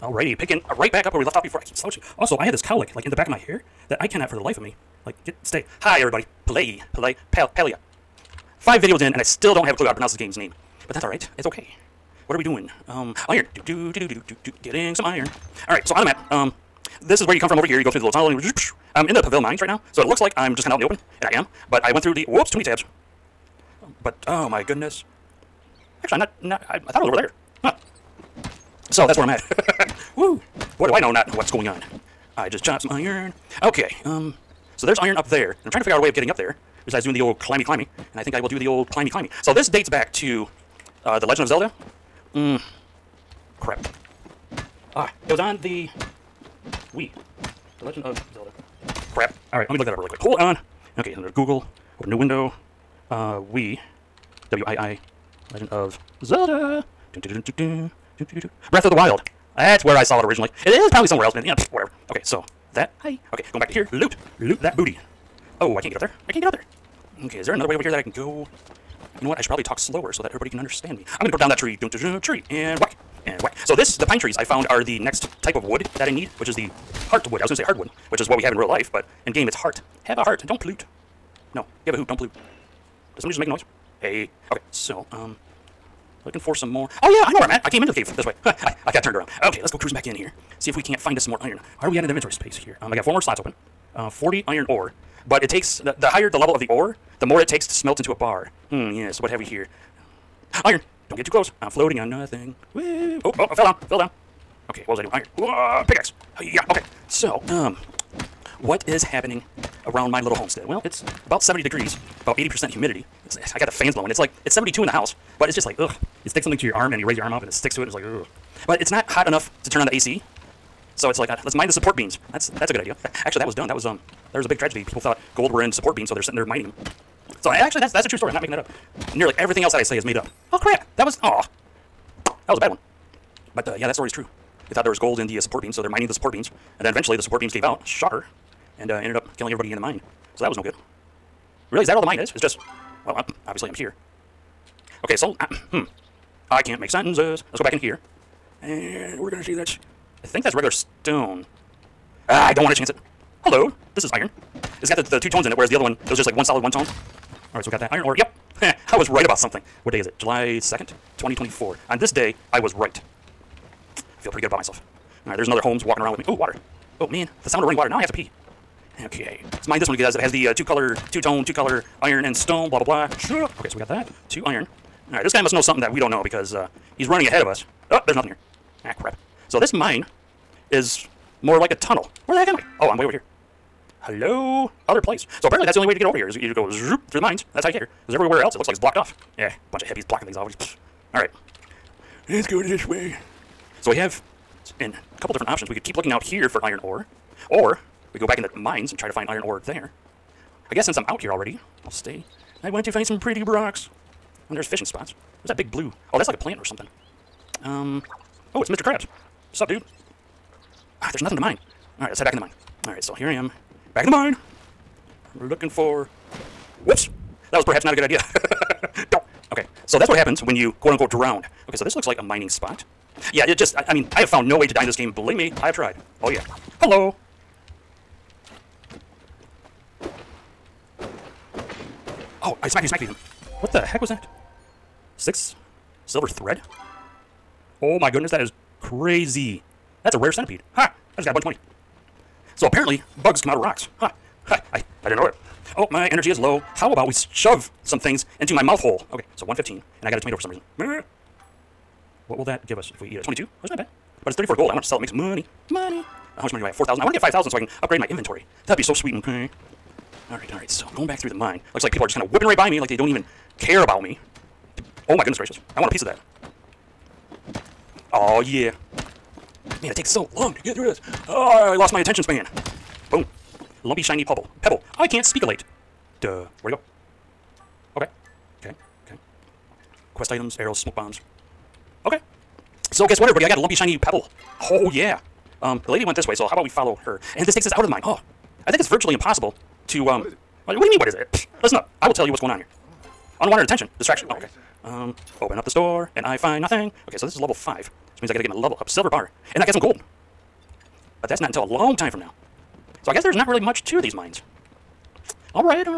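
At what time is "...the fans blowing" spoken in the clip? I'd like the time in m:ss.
1:53.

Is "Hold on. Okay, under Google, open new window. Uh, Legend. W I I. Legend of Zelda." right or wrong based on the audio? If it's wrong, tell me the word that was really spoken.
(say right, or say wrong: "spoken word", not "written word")
wrong: "Wii", not "Legend".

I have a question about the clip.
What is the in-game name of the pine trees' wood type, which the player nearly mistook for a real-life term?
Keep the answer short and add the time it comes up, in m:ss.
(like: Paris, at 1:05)
heartwood, at 1:17.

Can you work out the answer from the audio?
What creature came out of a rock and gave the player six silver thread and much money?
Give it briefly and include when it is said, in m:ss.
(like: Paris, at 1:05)
rare centipede, at 4:00.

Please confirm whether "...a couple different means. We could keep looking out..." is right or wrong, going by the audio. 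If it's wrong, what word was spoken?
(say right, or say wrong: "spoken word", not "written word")
wrong: "options", not "means".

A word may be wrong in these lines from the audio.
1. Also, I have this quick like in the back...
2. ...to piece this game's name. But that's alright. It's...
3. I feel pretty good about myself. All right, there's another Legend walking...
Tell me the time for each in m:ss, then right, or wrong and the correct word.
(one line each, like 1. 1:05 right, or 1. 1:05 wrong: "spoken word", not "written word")
1. 0:02 wrong: "cowlick", not "quick"
2. 0:09 wrong: "pronounce", not "piece"
3. 2:43 wrong: "Holmes", not "Legend".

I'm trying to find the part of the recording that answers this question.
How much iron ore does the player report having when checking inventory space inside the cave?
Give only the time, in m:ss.
1:34.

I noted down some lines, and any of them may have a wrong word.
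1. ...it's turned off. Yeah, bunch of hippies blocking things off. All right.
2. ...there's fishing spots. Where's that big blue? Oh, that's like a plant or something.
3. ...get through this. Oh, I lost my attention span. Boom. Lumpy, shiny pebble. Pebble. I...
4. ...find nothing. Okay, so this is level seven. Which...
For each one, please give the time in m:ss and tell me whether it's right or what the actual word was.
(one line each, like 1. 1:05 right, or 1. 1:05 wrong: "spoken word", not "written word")
1. 3:08 wrong: "blocked", not "turned"
2. 3:24 right
3. 4:30 right
4. 4:56 wrong: "five", not "seven".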